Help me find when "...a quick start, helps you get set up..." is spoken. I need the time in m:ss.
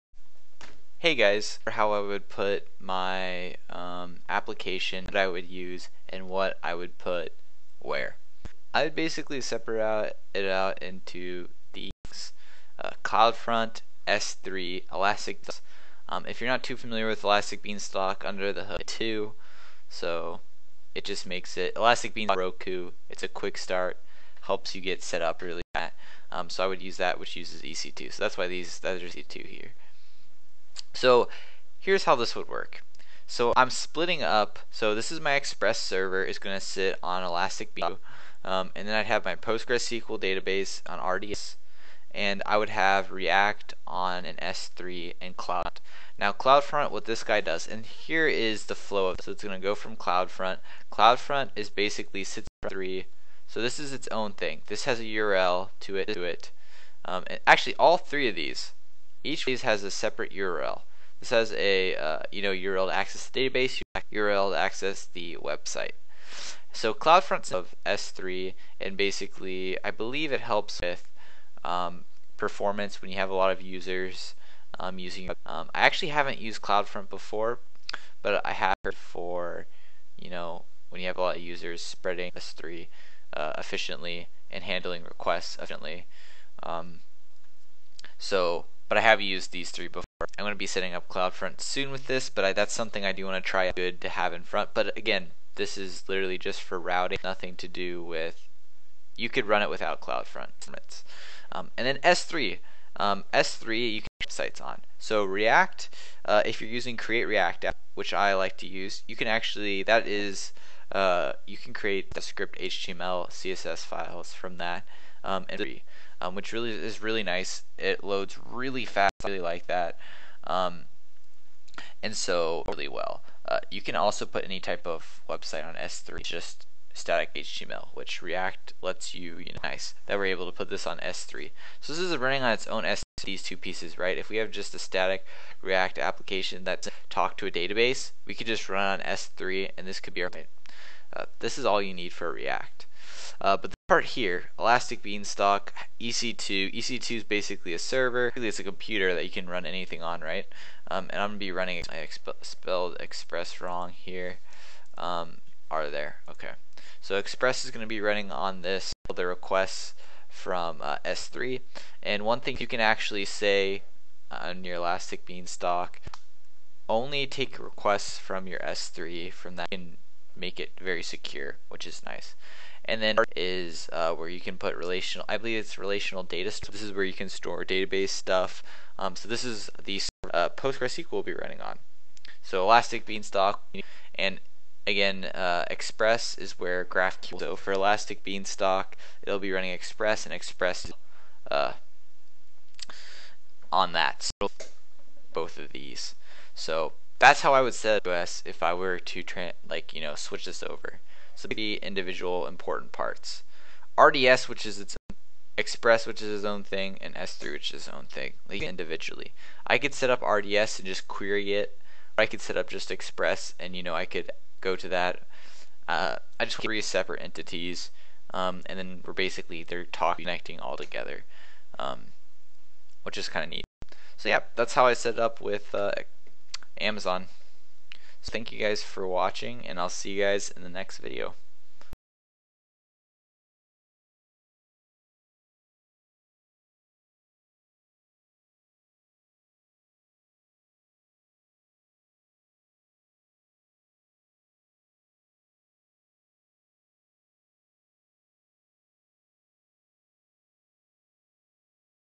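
0:23.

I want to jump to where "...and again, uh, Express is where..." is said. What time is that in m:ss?
3:04.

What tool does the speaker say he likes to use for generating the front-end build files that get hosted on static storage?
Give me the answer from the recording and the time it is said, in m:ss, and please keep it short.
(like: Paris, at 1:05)
Create React app, at 1:46.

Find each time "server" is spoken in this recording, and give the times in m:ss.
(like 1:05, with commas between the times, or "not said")
0:35, 2:27.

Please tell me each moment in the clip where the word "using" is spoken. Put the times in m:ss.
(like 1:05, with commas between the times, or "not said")
1:14, 1:46.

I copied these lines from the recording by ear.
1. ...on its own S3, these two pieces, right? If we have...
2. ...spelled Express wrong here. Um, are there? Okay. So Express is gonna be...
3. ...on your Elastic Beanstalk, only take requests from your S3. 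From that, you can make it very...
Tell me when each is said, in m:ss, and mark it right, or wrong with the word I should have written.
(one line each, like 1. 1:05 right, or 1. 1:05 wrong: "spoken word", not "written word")
1. 2:12 right
2. 2:32 right
3. 2:44 right.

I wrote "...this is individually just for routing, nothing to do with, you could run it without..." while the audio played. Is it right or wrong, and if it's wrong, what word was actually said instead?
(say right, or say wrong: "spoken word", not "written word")
wrong: "literally", not "individually".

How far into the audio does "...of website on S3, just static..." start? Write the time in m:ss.
2:04.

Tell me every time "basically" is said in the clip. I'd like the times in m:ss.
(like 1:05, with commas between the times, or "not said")
0:08, 0:51, 1:08, 2:27, 3:39.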